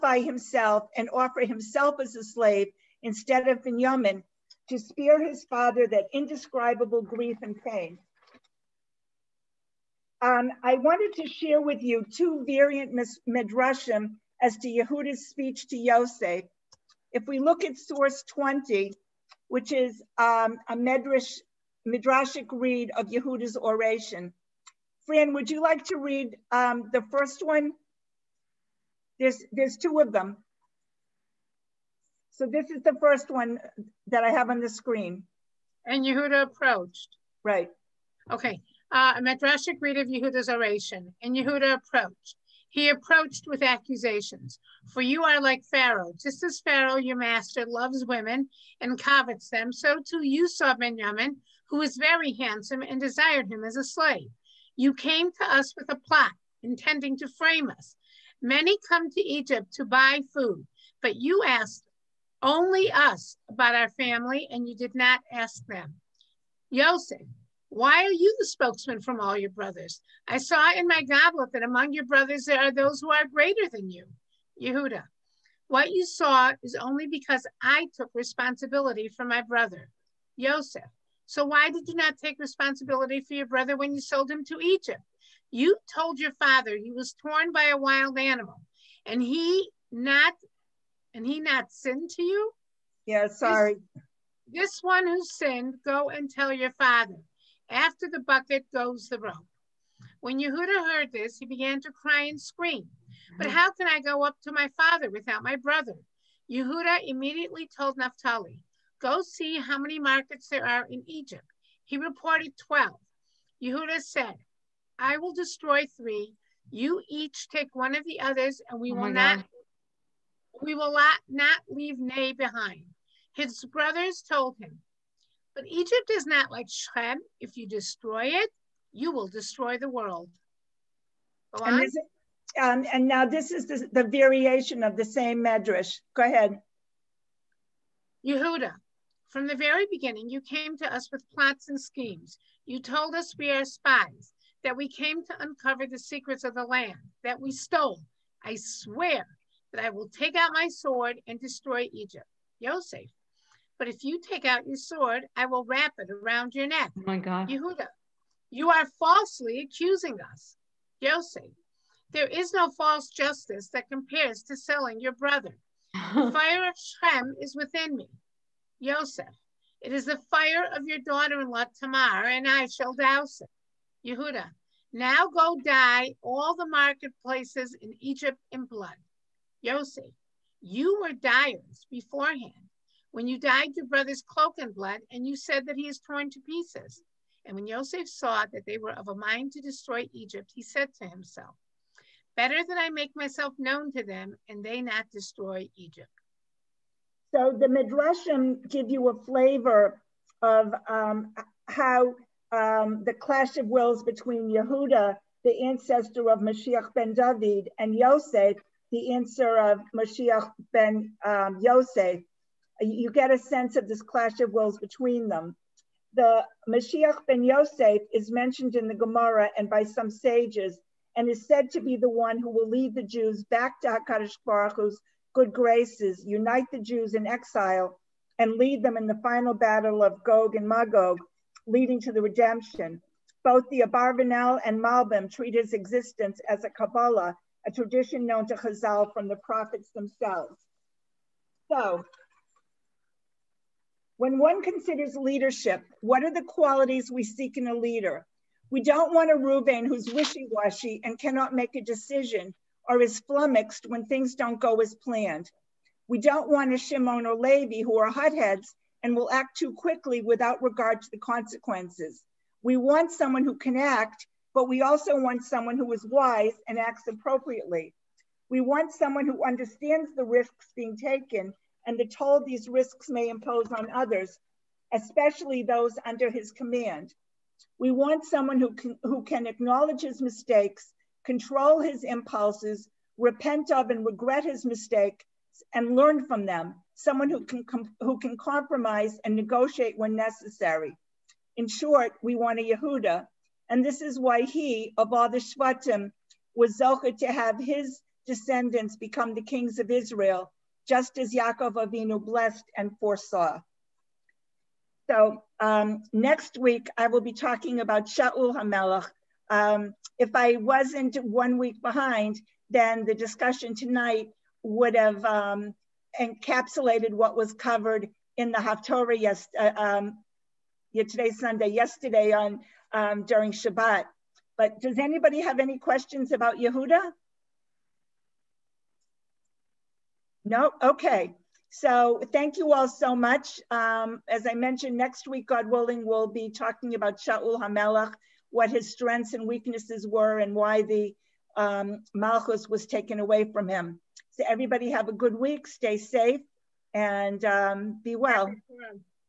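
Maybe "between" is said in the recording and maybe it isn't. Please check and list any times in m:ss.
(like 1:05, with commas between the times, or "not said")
3:24, 3:34.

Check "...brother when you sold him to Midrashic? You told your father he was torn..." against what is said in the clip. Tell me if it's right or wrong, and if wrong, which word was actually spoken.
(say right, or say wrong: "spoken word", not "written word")
wrong: "Egypt", not "Midrashic".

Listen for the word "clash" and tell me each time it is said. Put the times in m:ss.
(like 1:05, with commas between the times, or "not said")
3:23, 3:34.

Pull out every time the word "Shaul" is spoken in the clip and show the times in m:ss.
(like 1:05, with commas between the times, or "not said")
5:08, 5:37.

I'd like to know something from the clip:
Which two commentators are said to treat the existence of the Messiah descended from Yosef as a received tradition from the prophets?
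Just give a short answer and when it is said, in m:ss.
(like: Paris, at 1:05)
Abarbanel and Malbim, at 3:53.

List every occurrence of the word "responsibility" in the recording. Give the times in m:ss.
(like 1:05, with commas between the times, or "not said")
1:18, 1:22.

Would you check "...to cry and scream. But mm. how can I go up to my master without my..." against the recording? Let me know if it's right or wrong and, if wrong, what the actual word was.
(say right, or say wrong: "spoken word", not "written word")
wrong: "father", not "master".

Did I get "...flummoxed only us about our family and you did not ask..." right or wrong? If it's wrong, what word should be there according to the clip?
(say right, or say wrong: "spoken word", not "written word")
wrong: "asked", not "flummoxed".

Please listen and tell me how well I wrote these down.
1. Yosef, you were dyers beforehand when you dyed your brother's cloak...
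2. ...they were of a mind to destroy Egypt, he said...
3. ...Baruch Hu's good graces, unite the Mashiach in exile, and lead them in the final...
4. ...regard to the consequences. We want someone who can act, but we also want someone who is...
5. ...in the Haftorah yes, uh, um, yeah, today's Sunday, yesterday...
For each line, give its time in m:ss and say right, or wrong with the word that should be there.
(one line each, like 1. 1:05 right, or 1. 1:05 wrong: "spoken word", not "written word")
1. 2:59 right
2. 3:08 right
3. 3:44 wrong: "Jews", not "Mashiach"
4. 4:20 right
5. 5:18 right.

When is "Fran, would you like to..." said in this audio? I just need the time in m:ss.
0:25.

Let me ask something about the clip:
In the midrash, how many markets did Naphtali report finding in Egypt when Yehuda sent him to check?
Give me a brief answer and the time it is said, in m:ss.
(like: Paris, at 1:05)
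12, at 1:52.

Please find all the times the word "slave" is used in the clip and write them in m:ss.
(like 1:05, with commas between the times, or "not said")
0:02, 0:53.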